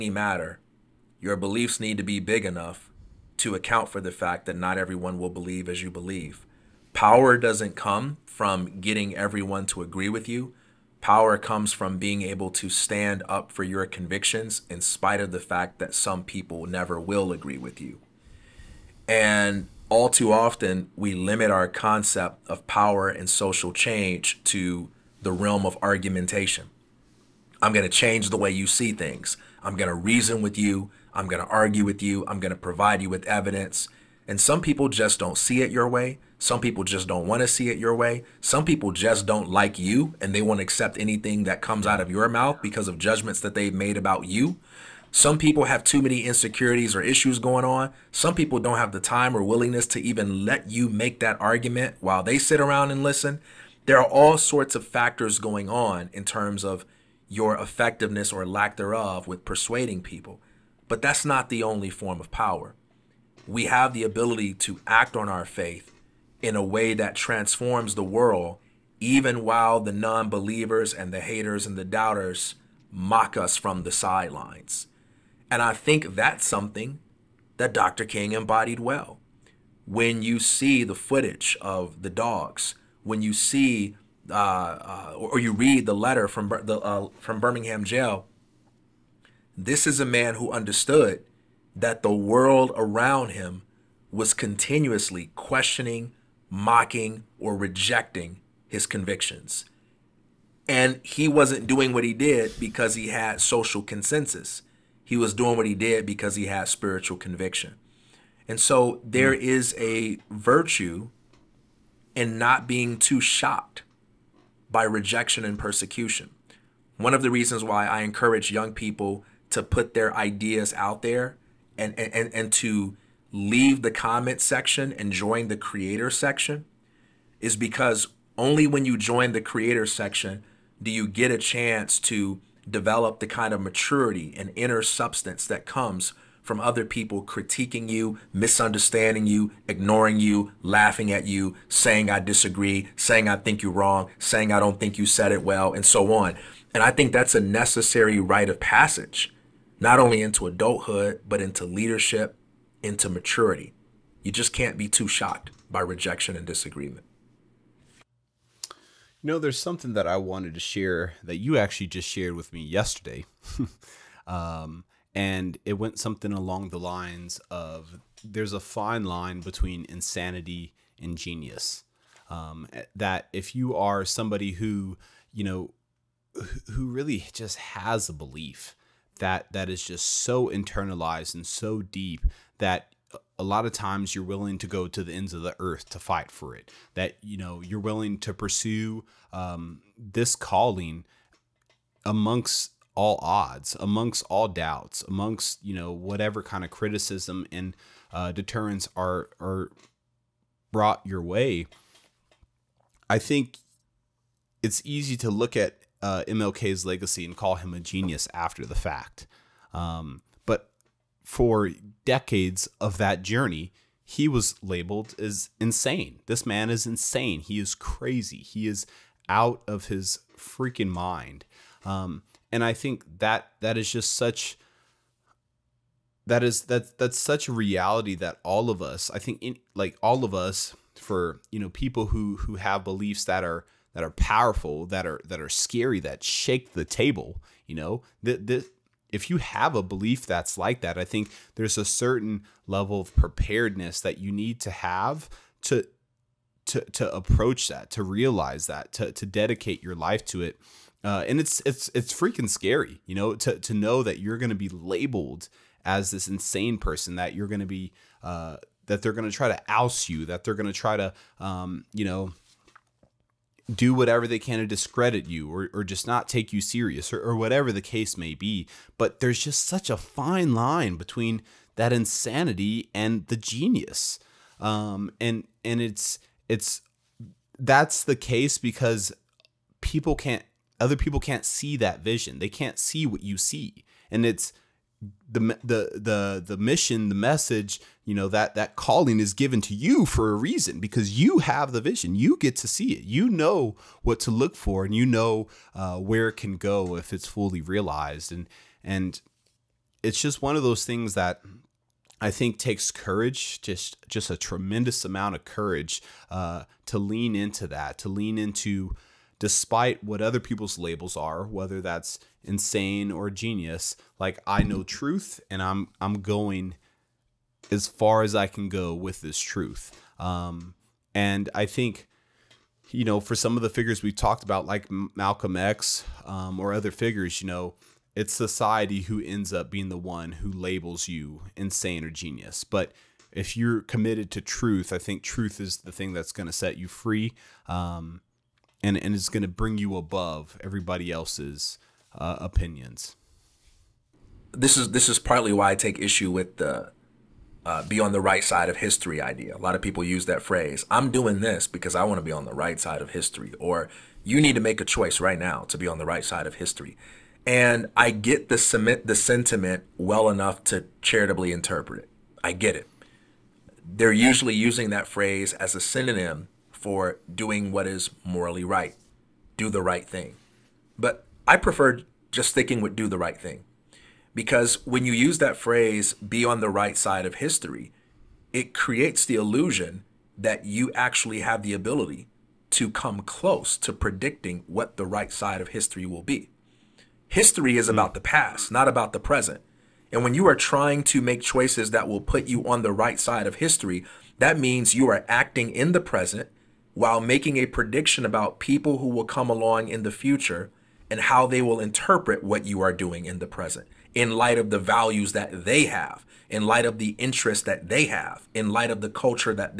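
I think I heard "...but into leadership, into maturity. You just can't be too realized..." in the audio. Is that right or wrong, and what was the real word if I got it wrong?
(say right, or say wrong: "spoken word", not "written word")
wrong: "shocked", not "realized".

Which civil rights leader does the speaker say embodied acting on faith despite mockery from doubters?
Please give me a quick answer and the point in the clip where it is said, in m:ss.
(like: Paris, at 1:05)
Dr. King, at 1:17.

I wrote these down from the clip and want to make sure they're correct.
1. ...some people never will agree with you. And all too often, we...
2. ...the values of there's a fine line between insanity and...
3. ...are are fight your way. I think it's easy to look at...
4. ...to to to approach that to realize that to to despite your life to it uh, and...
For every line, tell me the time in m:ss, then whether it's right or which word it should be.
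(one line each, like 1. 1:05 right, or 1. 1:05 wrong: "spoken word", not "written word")
1. 0:15 right
2. 2:46 wrong: "lines", not "values"
3. 3:18 wrong: "brought", not "fight"
4. 4:05 wrong: "dedicate", not "despite".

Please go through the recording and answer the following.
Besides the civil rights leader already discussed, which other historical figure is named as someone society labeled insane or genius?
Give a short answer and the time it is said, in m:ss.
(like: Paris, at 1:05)
Malcolm X, at 5:24.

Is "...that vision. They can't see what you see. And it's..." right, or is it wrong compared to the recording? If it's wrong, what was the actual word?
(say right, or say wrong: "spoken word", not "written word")
right.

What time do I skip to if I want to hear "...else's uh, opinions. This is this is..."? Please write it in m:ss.
5:41.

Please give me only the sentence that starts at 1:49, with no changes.
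is a virtue in not being too shocked by rejection and persecution.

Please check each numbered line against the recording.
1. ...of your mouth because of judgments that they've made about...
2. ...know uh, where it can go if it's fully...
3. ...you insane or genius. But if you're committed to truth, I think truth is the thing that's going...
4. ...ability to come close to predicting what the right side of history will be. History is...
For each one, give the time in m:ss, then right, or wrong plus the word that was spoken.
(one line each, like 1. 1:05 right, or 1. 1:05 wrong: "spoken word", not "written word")
1. 0:42 right
2. 4:55 right
3. 5:31 right
4. 6:21 right.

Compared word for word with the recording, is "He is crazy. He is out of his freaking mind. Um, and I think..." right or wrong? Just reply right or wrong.
right.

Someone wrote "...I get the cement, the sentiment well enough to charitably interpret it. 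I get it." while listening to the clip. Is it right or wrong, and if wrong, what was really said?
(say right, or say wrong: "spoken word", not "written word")
right.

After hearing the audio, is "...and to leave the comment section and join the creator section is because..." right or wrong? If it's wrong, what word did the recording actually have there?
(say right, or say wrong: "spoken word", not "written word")
right.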